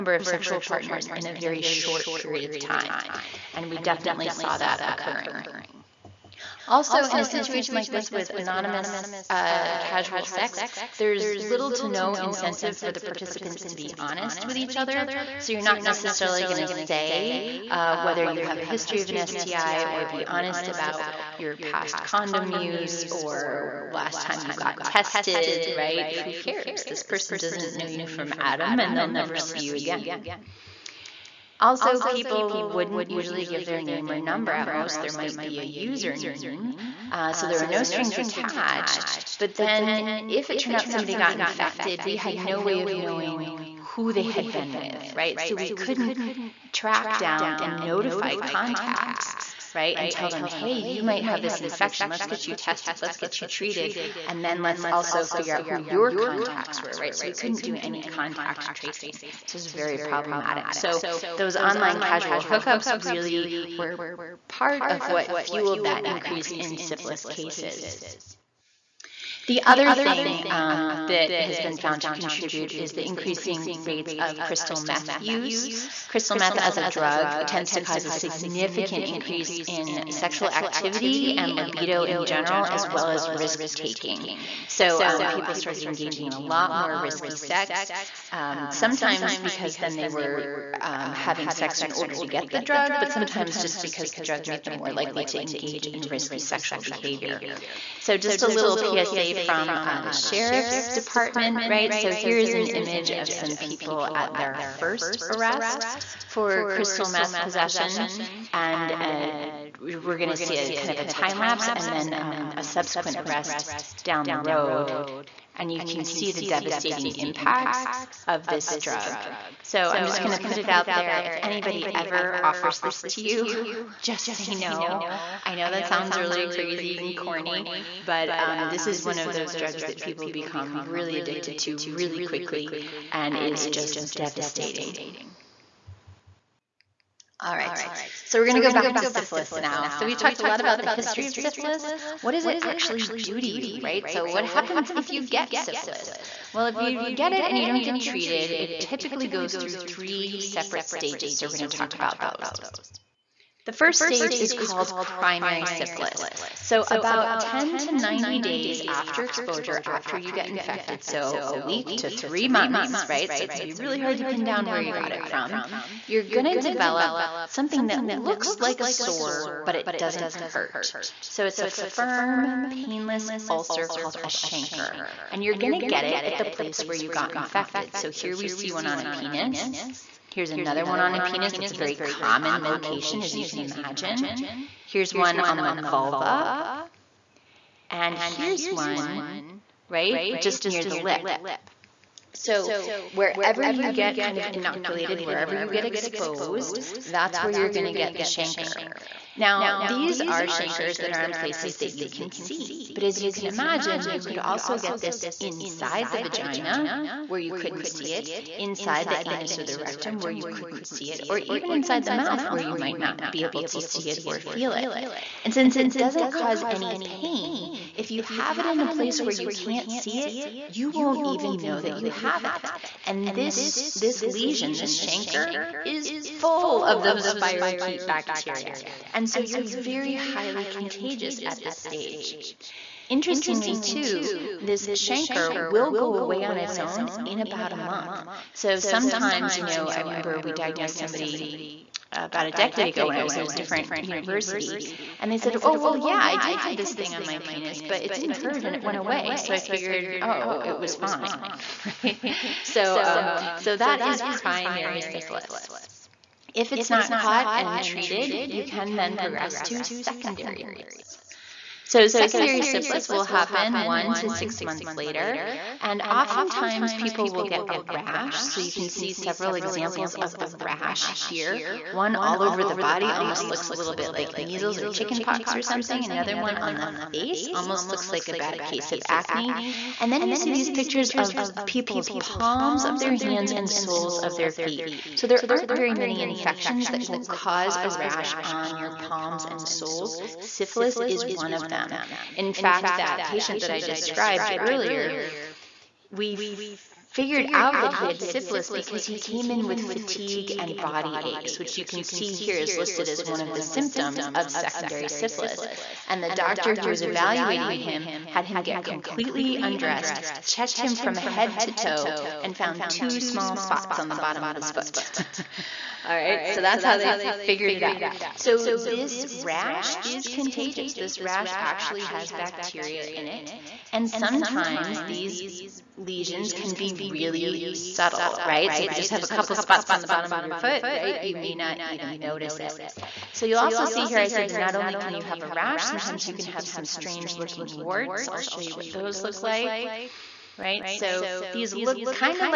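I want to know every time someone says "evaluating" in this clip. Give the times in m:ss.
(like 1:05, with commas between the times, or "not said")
5:07.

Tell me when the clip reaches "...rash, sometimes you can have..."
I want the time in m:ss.
5:35.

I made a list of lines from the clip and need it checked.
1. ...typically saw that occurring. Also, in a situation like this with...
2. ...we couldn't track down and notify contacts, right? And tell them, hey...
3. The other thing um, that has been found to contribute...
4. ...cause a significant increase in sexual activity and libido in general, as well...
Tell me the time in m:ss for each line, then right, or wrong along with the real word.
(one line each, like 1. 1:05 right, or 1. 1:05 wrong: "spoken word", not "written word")
1. 0:03 wrong: "definitely", not "typically"
2. 0:45 right
3. 1:09 right
4. 1:17 right.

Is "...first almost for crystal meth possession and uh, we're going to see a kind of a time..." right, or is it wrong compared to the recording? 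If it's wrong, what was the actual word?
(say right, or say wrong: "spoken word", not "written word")
wrong: "arrest", not "almost".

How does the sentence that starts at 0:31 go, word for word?
Also, people wouldn't usually give their name or number.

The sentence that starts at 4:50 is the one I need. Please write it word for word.
Syphilis is one of them them.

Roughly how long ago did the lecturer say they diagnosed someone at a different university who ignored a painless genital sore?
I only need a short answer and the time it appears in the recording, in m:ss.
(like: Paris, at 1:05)
A decade, at 4:02.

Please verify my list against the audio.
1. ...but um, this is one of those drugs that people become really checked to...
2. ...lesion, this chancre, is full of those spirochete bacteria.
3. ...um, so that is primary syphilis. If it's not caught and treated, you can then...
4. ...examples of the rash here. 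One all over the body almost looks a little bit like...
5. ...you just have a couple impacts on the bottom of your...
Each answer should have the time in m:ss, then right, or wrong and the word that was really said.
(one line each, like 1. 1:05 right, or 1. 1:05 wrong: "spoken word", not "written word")
1. 2:08 wrong: "addicted", not "checked"
2. 3:44 right
3. 4:13 right
4. 4:29 right
5. 5:28 wrong: "spots", not "impacts".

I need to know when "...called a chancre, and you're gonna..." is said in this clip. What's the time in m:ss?
2:53.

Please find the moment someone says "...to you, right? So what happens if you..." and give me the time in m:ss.
2:23.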